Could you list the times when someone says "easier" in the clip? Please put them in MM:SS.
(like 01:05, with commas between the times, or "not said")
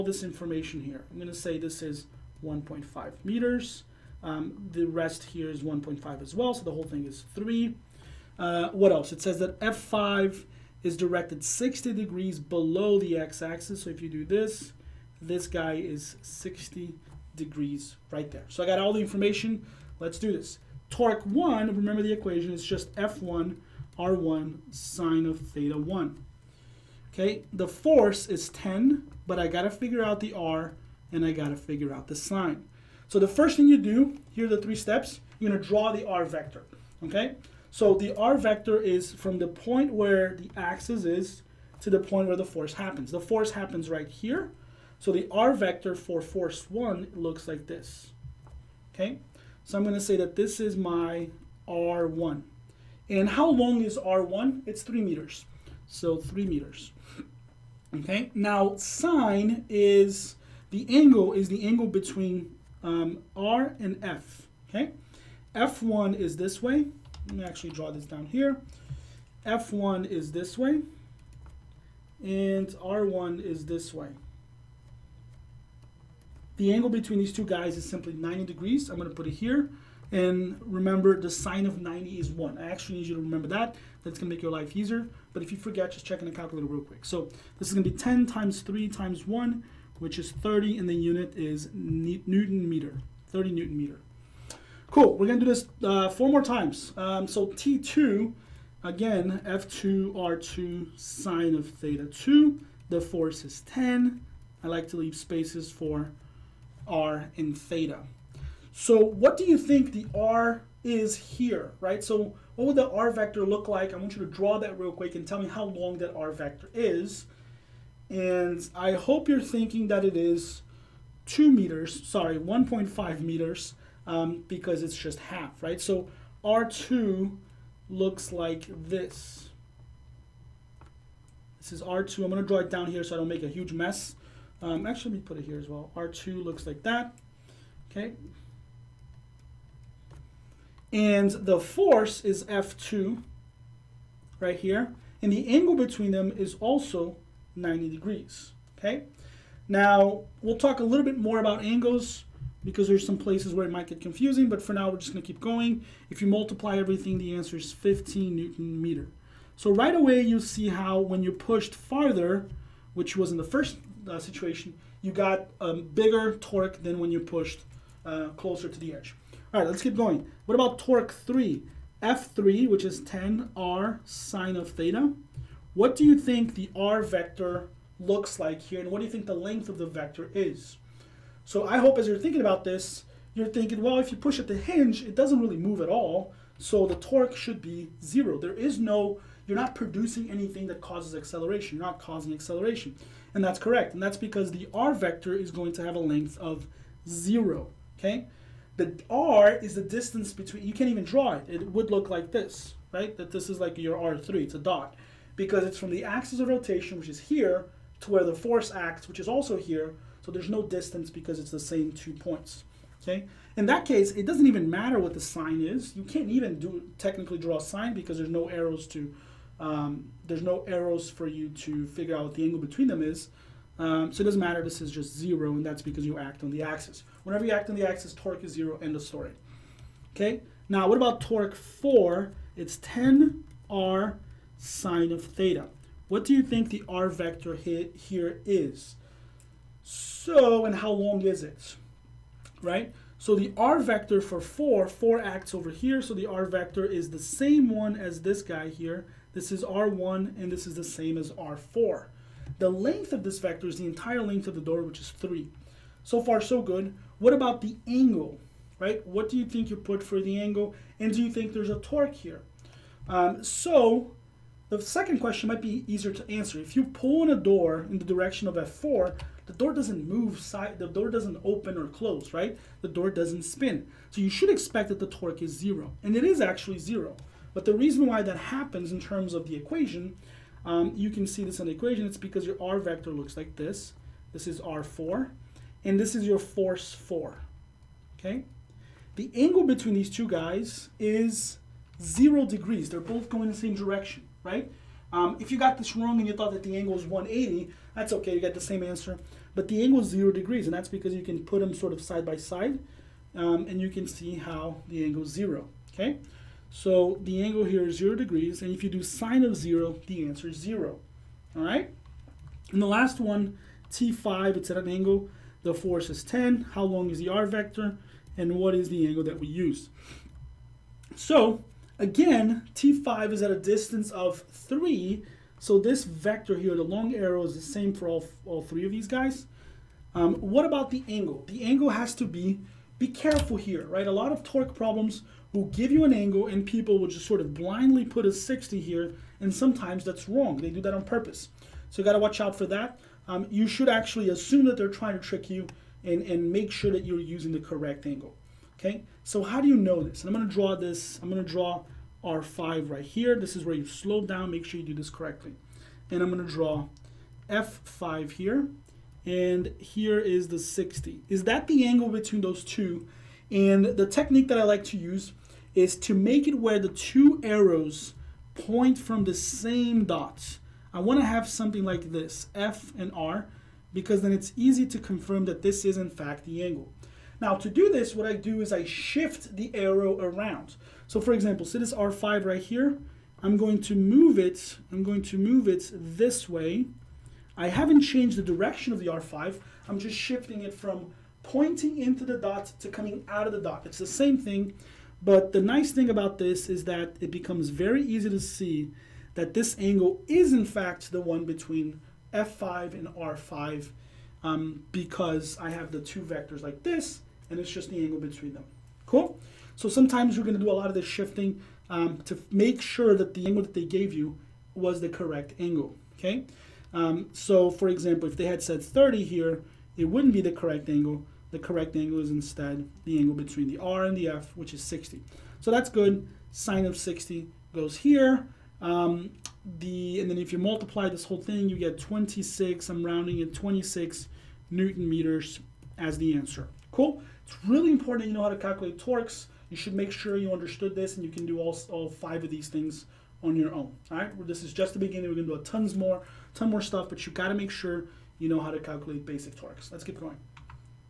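01:24, 04:25.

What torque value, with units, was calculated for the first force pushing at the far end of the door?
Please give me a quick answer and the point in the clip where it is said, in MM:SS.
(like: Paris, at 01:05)
30 newton meter, at 01:33.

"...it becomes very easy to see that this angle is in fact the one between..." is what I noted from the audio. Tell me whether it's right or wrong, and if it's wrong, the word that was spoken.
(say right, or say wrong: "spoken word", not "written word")
right.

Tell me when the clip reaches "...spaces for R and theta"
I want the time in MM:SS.
01:45.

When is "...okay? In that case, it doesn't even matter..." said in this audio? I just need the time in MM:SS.
03:33.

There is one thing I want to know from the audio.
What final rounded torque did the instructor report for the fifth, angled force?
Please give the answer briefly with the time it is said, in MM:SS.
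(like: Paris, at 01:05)
26 newton meters, at 07:13.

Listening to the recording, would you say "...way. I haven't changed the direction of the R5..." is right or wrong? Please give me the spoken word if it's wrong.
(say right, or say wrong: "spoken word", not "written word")
right.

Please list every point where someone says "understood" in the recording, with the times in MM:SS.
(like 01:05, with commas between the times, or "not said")
07:20.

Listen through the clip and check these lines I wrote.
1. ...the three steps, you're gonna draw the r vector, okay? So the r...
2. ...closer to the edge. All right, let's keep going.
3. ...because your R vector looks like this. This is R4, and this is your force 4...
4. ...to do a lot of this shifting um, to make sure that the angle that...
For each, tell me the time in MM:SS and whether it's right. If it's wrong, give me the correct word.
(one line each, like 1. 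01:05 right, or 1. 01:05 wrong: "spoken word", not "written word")
1. 00:34 right
2. 02:48 right
3. 04:42 right
4. 06:50 right.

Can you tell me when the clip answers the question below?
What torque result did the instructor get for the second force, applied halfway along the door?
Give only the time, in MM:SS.
02:37.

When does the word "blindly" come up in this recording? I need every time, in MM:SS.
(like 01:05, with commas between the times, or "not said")
05:37.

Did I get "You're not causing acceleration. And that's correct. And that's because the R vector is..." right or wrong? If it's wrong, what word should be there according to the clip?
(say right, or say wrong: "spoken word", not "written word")
right.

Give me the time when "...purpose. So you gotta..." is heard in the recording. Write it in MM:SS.
05:41.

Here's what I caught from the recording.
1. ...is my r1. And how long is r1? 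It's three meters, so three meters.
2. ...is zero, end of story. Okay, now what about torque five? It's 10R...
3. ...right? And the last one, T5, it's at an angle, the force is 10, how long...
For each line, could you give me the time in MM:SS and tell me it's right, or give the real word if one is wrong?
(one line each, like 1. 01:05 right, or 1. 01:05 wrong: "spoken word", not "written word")
1. 00:50 right
2. 03:48 wrong: "four", not "five"
3. 05:11 right.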